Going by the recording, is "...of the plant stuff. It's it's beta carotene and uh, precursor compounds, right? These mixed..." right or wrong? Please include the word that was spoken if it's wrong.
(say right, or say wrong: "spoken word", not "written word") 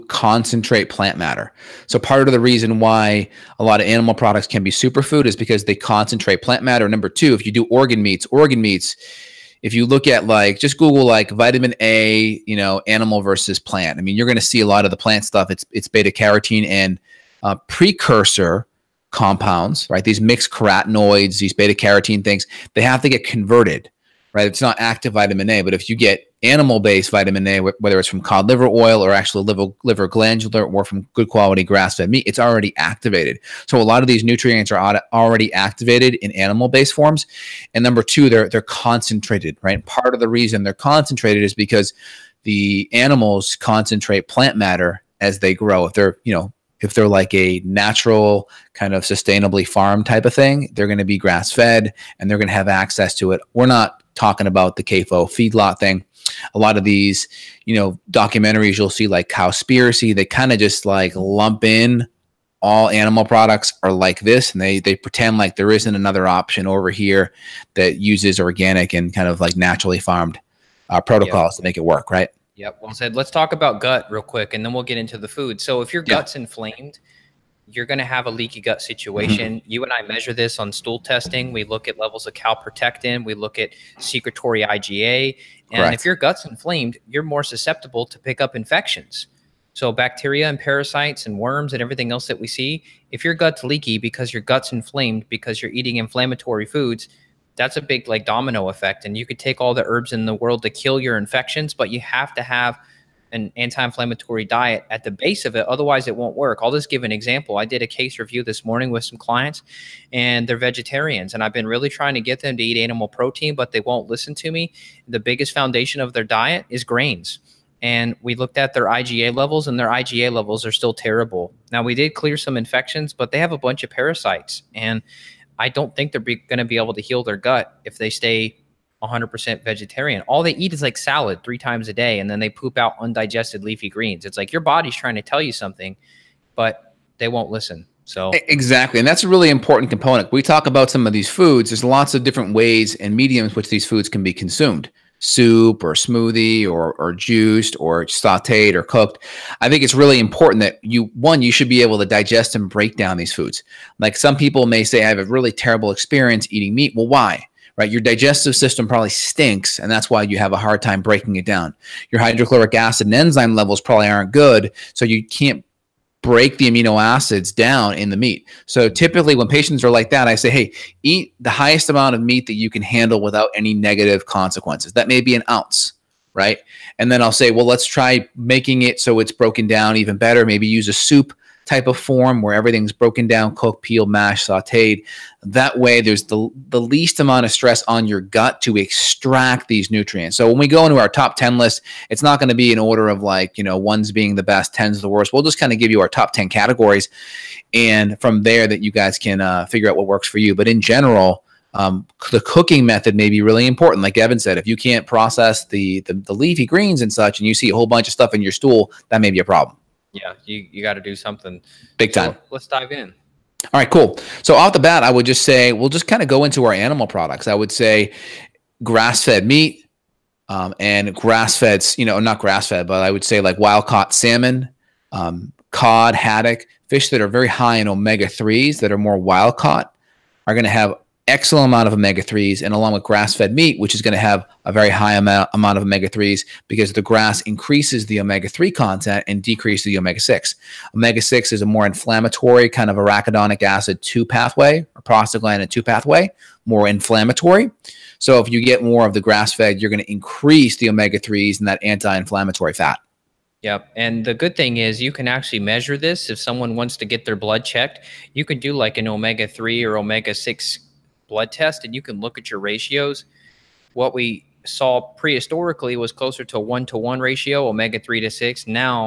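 right.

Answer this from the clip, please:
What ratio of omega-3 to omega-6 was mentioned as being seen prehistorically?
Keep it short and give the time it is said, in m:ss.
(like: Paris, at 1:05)
1 to 1, at 4:26.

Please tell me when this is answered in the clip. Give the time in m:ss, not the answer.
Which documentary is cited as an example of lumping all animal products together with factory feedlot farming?
0:59.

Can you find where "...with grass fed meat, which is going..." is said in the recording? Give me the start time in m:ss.
3:52.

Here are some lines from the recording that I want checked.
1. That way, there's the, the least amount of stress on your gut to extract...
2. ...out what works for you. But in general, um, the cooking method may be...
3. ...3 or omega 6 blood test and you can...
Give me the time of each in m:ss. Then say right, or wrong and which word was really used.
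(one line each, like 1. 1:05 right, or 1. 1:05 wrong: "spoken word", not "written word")
1. 3:05 right
2. 3:19 right
3. 4:19 right.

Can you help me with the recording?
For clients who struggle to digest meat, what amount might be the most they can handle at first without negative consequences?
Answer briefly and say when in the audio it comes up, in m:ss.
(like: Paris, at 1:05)
An ounce, at 2:55.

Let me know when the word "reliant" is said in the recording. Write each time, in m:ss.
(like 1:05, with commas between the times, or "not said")
not said.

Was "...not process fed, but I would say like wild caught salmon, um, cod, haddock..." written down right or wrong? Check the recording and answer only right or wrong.
wrong.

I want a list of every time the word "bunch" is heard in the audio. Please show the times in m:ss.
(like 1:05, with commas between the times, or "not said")
2:03, 3:27.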